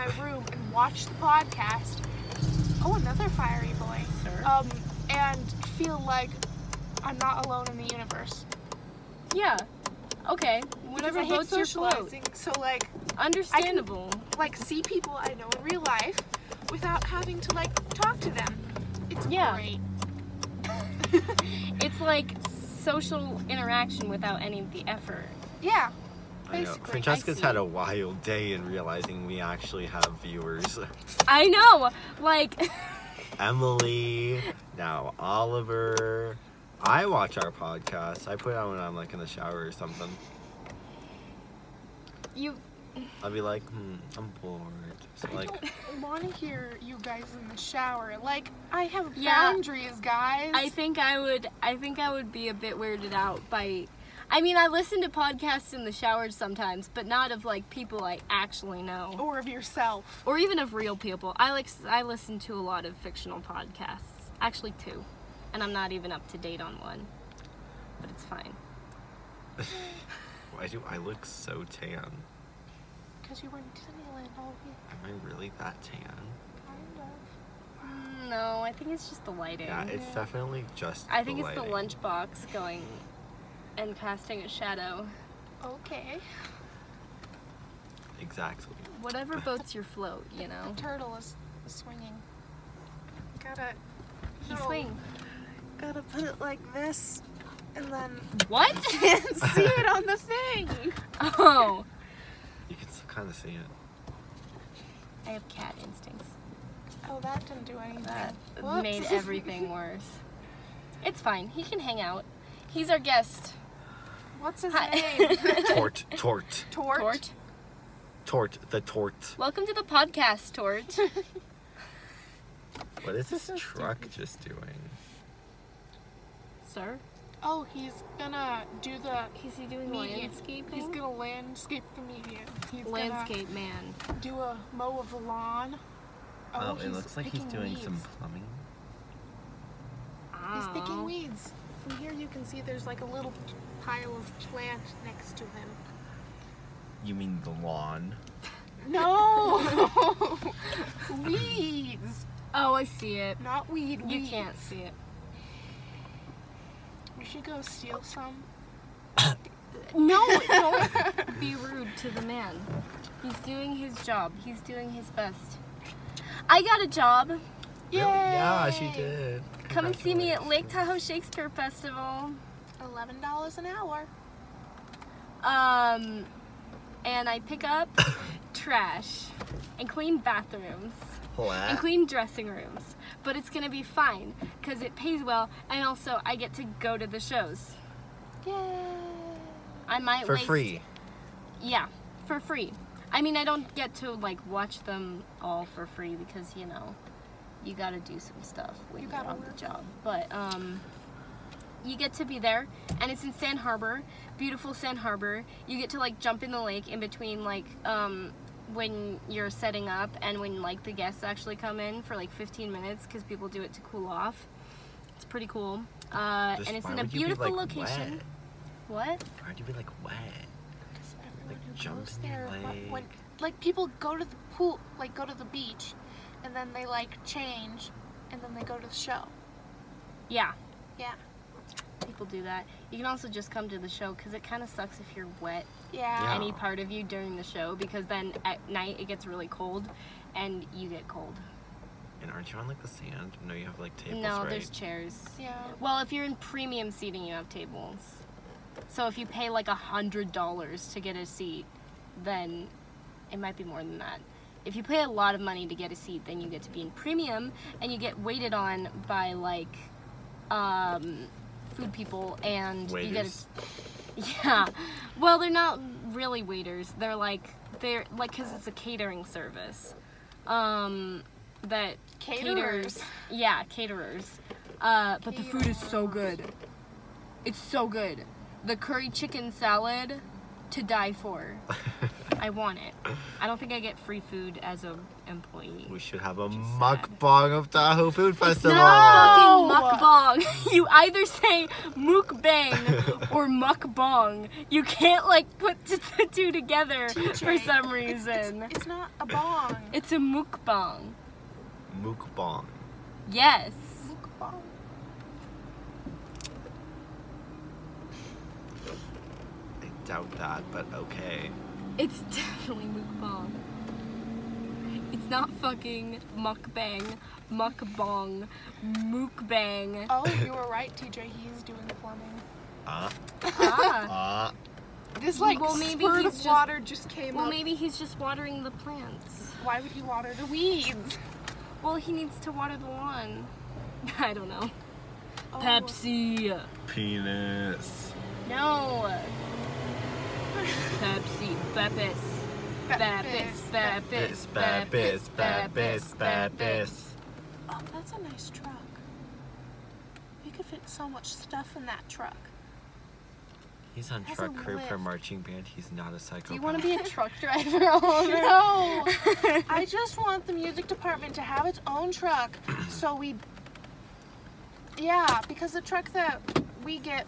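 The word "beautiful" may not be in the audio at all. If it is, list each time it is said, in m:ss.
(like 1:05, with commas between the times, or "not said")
3:24, 3:37.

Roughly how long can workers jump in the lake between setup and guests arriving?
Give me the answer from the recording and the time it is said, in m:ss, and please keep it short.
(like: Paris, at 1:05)
15 minutes, at 3:32.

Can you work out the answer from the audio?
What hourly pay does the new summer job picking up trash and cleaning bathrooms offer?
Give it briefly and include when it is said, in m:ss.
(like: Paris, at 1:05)
$11 an hour, at 2:52.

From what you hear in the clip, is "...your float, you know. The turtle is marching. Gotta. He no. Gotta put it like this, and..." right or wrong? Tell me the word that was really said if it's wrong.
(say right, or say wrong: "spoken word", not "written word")
wrong: "swinging", not "marching".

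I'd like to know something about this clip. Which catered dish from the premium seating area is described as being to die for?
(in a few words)
Curry chicken salad.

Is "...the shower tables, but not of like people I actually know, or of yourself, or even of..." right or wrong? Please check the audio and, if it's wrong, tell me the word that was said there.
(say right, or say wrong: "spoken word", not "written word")
wrong: "sometimes", not "tables".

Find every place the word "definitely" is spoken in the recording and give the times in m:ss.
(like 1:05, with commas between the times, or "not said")
1:20, 5:12.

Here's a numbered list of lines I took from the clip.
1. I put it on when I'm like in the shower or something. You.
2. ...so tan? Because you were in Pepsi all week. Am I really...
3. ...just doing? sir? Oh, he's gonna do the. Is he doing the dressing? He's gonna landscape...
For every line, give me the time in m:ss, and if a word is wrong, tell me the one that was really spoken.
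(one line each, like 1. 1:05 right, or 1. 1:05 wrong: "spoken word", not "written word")
1. 0:38 right
2. 1:11 wrong: "Disneyland", not "Pepsi"
3. 2:04 wrong: "landscaping", not "dressing".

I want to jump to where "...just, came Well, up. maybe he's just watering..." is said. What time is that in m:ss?
5:26.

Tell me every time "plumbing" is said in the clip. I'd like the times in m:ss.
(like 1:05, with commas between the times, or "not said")
2:18, 5:21.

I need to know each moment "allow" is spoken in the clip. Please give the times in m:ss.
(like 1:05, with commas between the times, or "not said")
not said.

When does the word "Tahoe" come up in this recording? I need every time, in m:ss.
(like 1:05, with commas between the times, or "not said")
2:50, 4:47.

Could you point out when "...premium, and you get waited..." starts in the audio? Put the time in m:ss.
4:16.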